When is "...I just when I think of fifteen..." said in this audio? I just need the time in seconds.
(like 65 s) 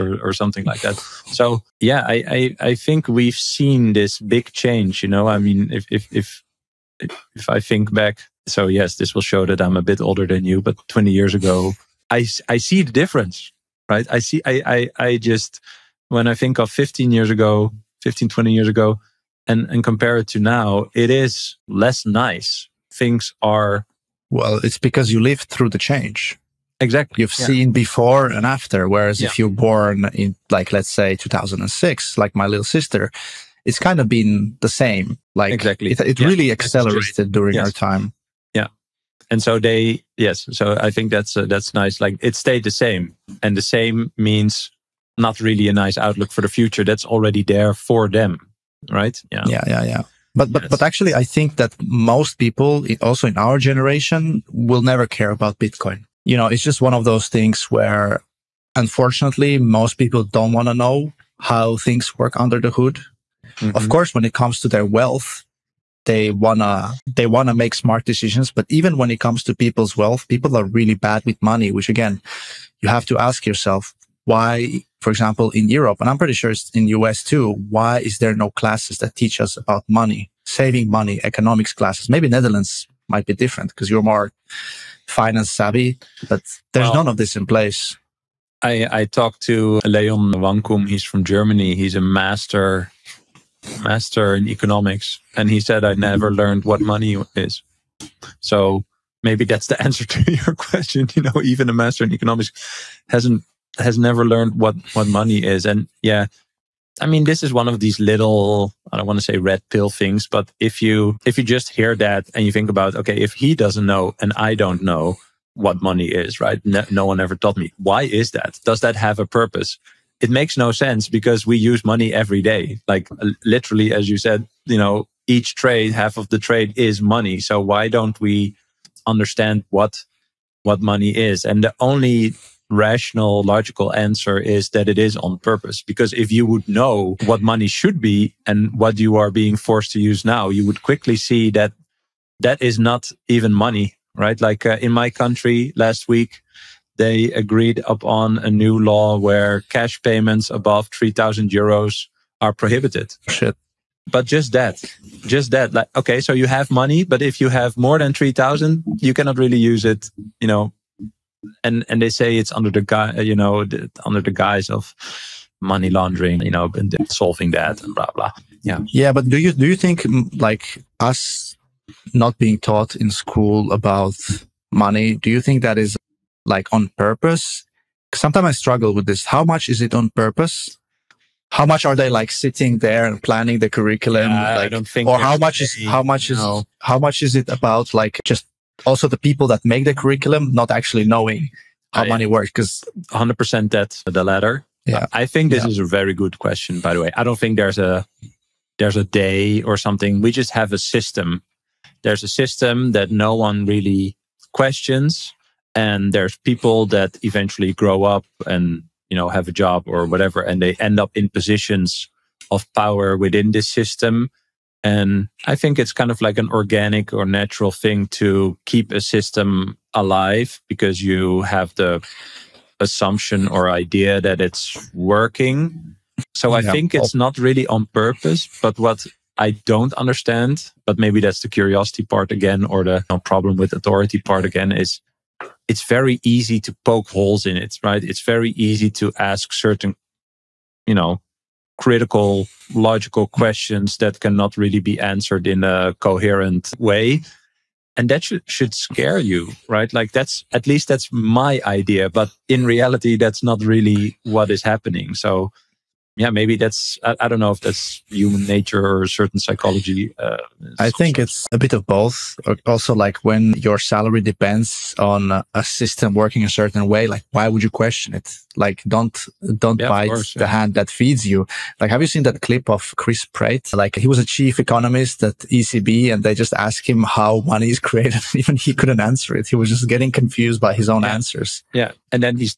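15 s.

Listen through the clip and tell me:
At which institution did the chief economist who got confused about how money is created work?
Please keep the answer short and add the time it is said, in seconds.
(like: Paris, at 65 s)
ECB, at 275 s.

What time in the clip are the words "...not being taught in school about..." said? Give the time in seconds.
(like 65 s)
172 s.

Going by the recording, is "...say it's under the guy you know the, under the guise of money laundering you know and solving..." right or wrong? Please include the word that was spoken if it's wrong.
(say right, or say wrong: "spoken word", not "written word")
right.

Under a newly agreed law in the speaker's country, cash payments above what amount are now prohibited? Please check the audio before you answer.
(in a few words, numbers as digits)
3,000 euros.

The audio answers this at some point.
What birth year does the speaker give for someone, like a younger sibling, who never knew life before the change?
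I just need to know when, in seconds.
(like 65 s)
31 s.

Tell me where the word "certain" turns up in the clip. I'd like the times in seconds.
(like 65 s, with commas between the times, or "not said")
239 s, 259 s, 266 s.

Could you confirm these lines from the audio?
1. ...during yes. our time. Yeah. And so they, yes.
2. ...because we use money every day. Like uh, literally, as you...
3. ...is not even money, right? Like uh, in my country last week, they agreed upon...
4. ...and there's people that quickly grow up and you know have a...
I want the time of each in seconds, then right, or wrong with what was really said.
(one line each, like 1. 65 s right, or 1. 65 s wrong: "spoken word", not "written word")
1. 37 s right
2. 121 s right
3. 142 s right
4. 205 s wrong: "eventually", not "quickly".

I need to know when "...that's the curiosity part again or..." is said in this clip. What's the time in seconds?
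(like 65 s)
231 s.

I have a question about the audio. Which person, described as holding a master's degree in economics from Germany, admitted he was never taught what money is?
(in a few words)
Leon Wankum.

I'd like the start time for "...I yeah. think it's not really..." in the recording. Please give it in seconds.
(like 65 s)
226 s.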